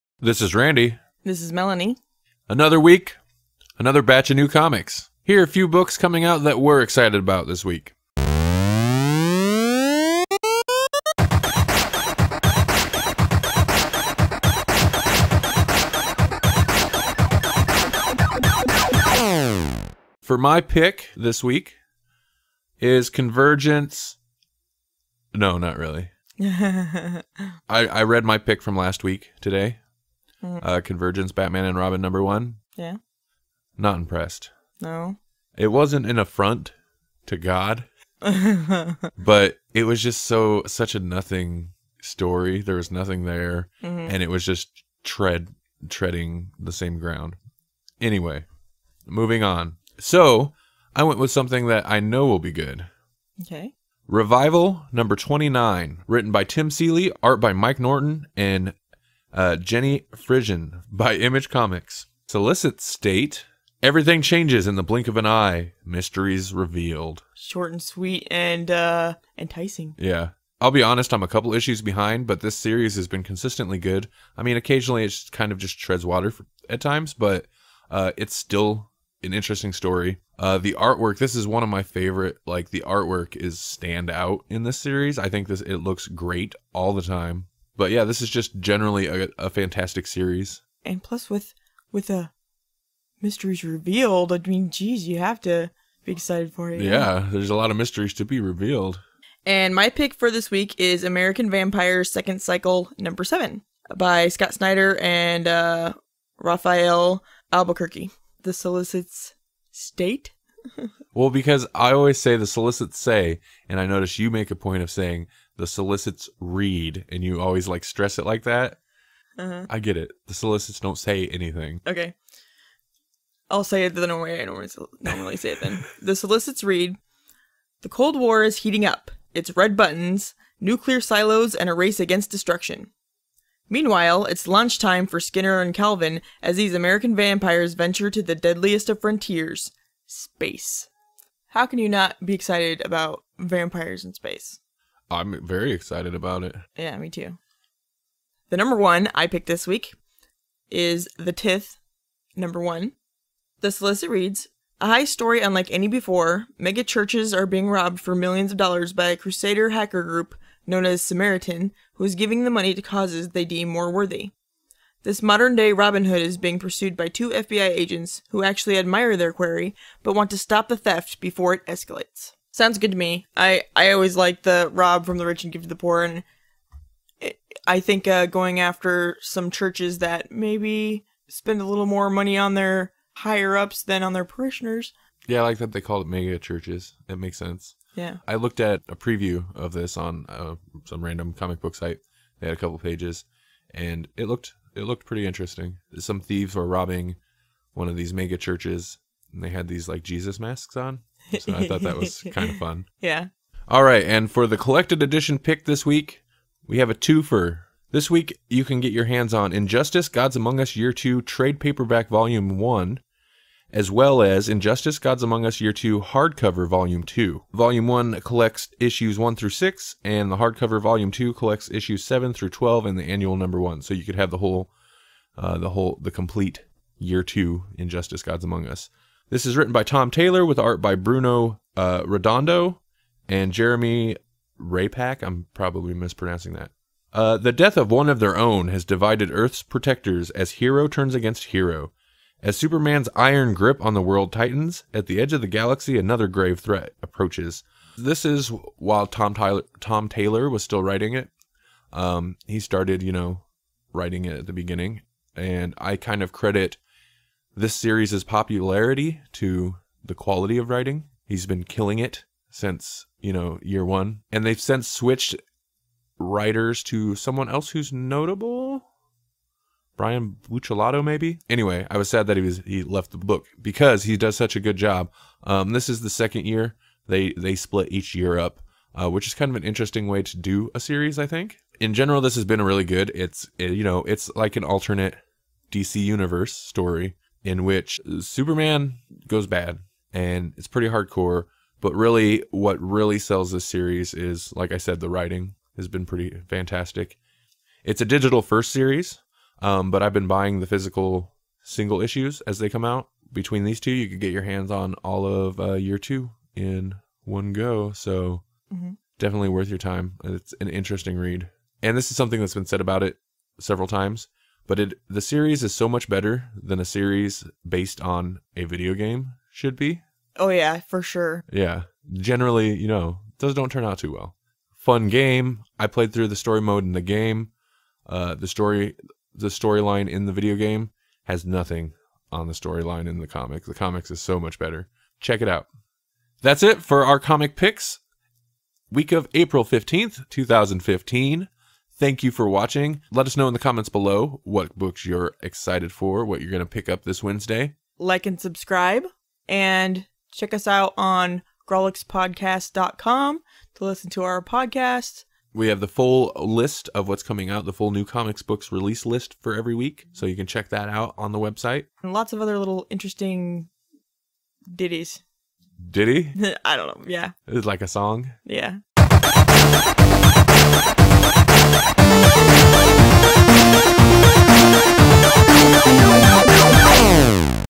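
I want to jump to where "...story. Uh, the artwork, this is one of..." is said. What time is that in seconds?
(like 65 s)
79 s.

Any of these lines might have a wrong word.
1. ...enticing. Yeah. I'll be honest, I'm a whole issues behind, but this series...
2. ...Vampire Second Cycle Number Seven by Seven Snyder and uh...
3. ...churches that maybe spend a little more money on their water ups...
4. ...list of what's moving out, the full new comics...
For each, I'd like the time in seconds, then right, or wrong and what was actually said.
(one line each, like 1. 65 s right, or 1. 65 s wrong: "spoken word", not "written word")
1. 69 s wrong: "couple", not "whole"
2. 101 s wrong: "Scott", not "Seven"
3. 179 s wrong: "higher", not "water"
4. 356 s wrong: "coming", not "moving".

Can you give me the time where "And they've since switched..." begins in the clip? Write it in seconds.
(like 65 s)
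264 s.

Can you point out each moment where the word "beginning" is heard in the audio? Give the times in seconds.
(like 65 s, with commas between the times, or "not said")
254 s.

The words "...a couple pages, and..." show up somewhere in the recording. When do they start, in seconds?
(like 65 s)
192 s.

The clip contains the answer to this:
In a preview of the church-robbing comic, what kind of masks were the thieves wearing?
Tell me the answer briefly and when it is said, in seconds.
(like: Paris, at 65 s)
Jesus masks, at 200 s.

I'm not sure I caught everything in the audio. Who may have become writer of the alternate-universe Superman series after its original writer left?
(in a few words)
Brian Buccellato.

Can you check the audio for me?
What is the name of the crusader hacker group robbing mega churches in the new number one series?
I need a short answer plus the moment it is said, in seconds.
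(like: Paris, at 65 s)
Samaritan, at 161 s.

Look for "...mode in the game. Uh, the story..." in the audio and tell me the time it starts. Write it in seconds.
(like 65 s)
326 s.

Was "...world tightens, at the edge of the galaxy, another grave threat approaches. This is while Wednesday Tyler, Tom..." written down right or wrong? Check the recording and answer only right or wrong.
wrong.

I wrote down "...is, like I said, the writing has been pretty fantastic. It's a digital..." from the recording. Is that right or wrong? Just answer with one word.
right.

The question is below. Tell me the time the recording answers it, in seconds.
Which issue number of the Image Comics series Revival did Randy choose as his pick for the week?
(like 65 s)
54 s.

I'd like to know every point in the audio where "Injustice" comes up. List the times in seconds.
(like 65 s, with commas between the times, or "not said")
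209 s, 214 s, 227 s.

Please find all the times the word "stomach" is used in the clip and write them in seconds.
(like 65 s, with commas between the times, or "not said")
not said.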